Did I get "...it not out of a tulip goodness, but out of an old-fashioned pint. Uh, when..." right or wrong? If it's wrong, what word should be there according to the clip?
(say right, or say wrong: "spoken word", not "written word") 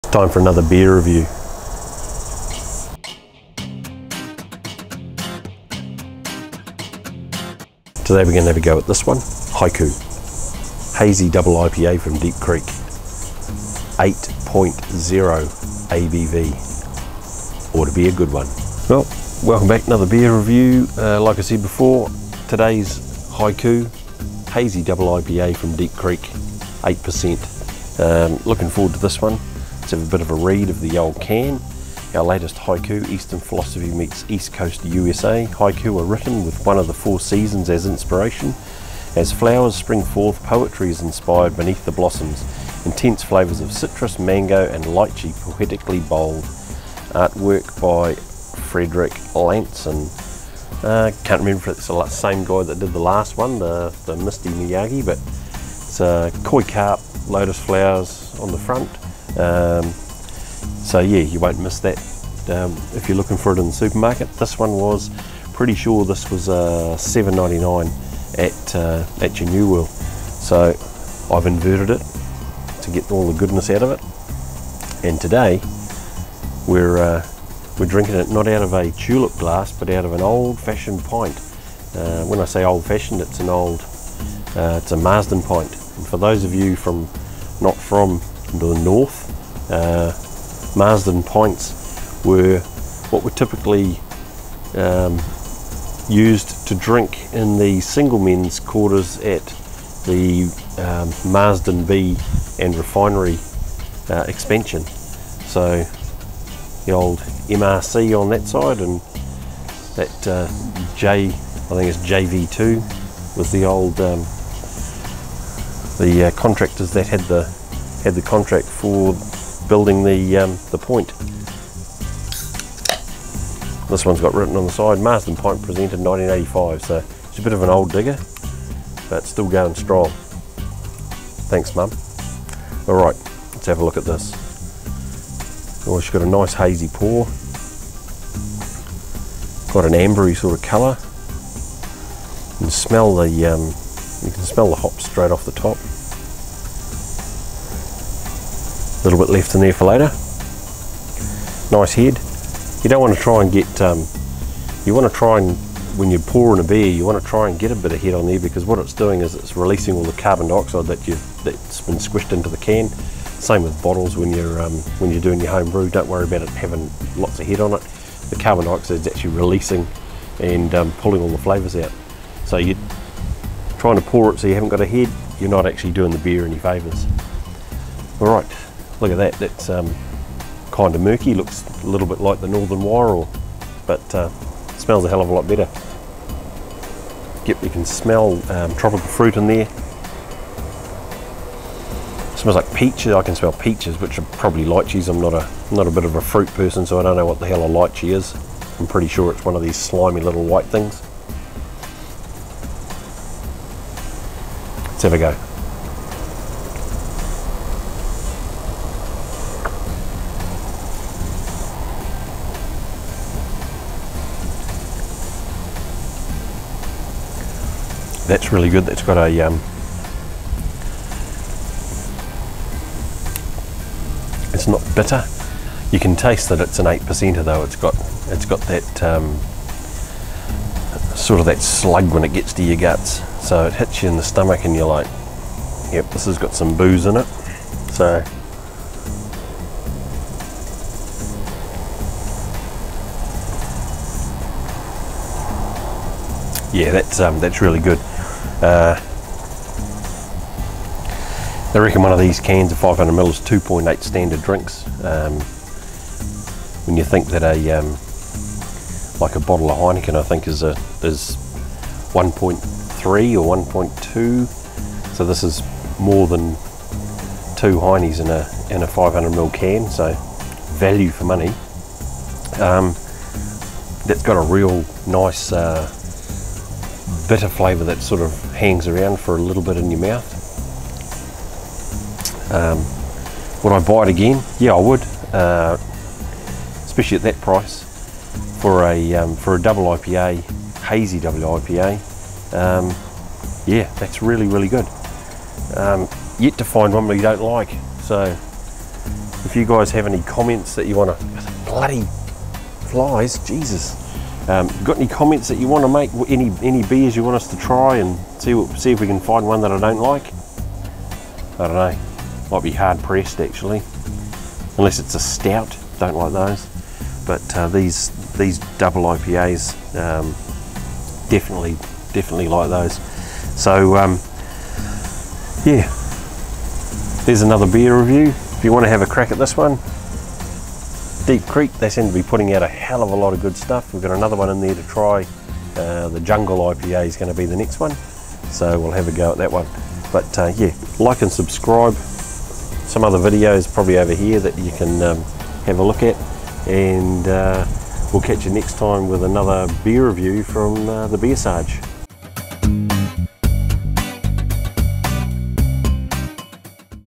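wrong: "glass", not "goodness".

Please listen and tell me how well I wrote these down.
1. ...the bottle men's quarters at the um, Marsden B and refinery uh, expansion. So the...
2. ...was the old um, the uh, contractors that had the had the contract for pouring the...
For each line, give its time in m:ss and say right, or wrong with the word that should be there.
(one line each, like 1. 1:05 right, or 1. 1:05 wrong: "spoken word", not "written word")
1. 1:37 wrong: "single", not "bottle"
2. 1:53 wrong: "building", not "pouring".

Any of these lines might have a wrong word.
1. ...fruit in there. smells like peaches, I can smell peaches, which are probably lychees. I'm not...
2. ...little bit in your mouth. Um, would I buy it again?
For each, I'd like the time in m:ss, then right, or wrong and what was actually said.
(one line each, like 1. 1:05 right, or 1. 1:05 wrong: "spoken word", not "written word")
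1. 3:09 right
2. 4:39 right.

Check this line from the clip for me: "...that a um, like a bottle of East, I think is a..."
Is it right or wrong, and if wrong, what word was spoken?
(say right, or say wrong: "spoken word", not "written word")
wrong: "Heineken", not "East".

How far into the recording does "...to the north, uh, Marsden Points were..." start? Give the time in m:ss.
1:28.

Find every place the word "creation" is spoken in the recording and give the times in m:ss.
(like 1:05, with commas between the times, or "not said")
not said.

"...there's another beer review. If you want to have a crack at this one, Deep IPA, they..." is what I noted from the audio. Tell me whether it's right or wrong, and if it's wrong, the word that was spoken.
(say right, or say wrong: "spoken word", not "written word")
wrong: "Creek", not "IPA".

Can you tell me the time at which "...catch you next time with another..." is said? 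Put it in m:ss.
5:48.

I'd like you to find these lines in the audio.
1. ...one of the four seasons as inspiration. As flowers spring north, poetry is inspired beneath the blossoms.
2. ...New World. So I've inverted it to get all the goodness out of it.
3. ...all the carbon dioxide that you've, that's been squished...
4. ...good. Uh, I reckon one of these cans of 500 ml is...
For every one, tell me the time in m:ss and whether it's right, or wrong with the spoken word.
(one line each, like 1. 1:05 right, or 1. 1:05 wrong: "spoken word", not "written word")
1. 0:36 wrong: "forth", not "north"
2. 1:09 right
3. 2:39 right
4. 4:07 right.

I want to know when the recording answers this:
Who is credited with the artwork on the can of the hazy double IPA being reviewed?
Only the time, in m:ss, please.
0:48.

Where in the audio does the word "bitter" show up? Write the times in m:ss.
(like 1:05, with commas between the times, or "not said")
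3:44, 4:37.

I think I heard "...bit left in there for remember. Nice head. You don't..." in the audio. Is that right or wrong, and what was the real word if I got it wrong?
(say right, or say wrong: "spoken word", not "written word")
wrong: "later", not "remember".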